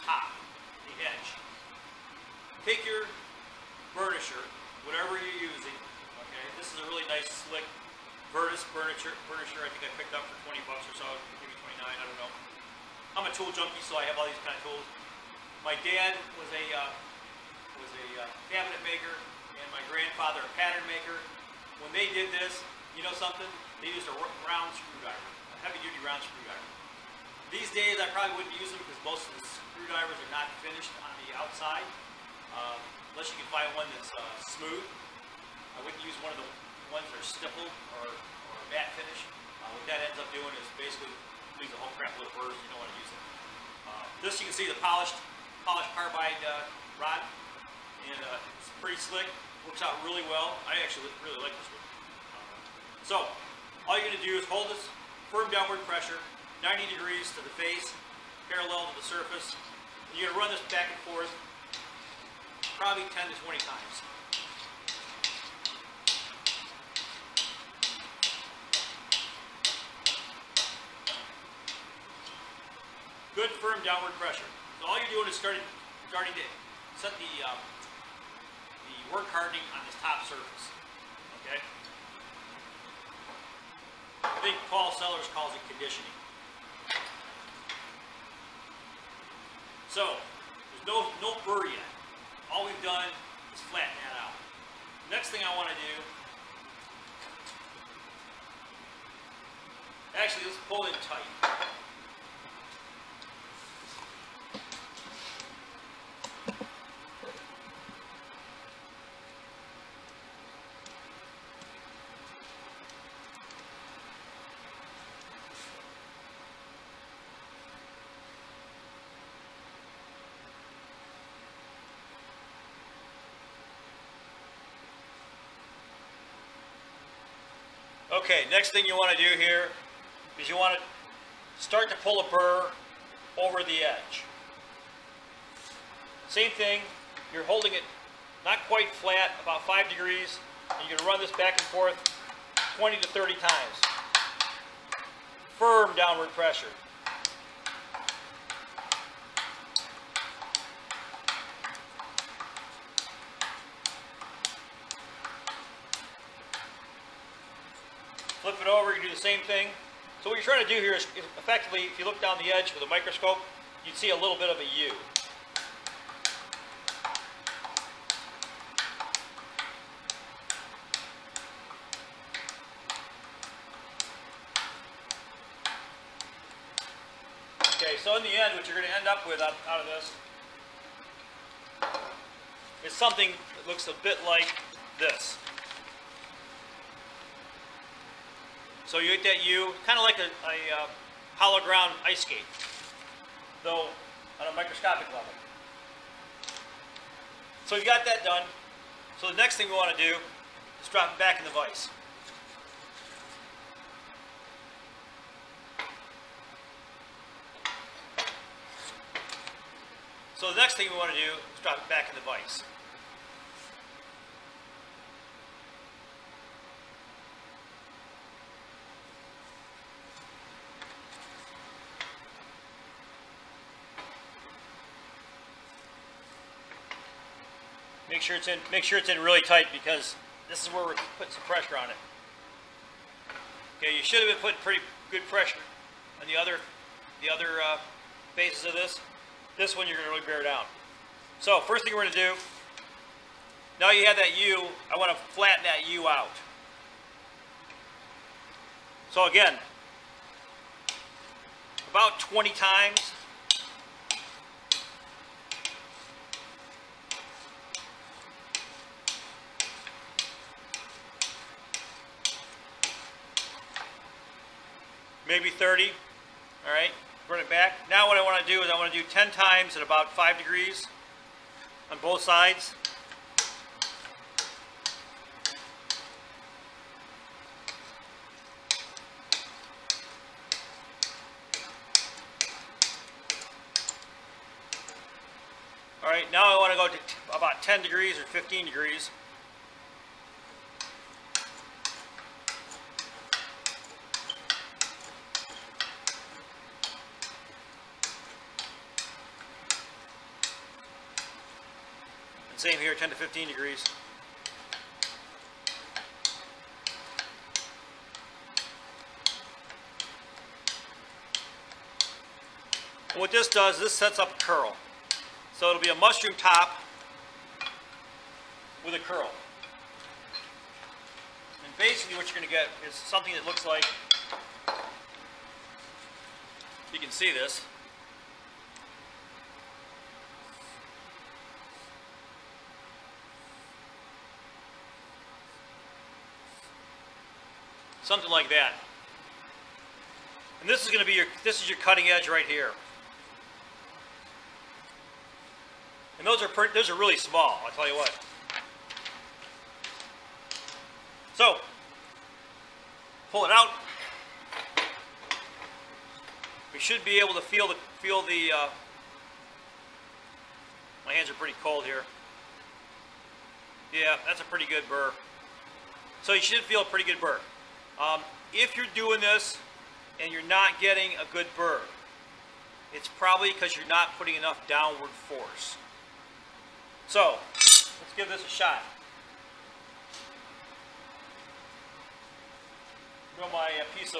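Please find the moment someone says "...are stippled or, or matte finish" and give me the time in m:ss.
0:37.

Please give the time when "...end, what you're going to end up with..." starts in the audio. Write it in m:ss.
2:58.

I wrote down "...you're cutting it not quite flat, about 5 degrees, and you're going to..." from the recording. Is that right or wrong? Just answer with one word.
wrong.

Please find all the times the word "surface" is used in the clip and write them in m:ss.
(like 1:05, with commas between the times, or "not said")
0:59, 1:20.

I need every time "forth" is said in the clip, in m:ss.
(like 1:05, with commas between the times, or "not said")
1:01, 2:21.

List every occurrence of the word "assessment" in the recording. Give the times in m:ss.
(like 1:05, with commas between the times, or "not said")
not said.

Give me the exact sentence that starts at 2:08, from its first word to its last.
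Okay, next thing you want to do here is you want to start to pull a burr over the edge.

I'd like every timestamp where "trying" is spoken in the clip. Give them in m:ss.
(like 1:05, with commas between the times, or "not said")
2:40.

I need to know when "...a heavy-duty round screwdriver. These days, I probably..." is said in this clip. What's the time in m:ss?
0:25.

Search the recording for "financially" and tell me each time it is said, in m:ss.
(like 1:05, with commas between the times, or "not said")
not said.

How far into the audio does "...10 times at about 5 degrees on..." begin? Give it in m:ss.
4:29.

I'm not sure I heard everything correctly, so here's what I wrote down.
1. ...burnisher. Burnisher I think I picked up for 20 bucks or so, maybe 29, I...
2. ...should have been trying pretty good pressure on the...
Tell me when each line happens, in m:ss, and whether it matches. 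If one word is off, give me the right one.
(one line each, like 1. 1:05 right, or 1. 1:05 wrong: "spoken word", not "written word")
1. 0:08 right
2. 3:54 wrong: "putting", not "trying".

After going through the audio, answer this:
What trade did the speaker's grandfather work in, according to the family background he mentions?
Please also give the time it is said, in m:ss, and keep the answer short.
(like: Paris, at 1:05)
Pattern maker, at 0:20.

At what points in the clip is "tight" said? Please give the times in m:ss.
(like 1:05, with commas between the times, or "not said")
1:41, 3:49.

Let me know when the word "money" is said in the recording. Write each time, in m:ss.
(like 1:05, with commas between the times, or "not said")
not said.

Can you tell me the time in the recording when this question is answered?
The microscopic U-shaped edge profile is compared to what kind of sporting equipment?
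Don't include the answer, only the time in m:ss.
3:11.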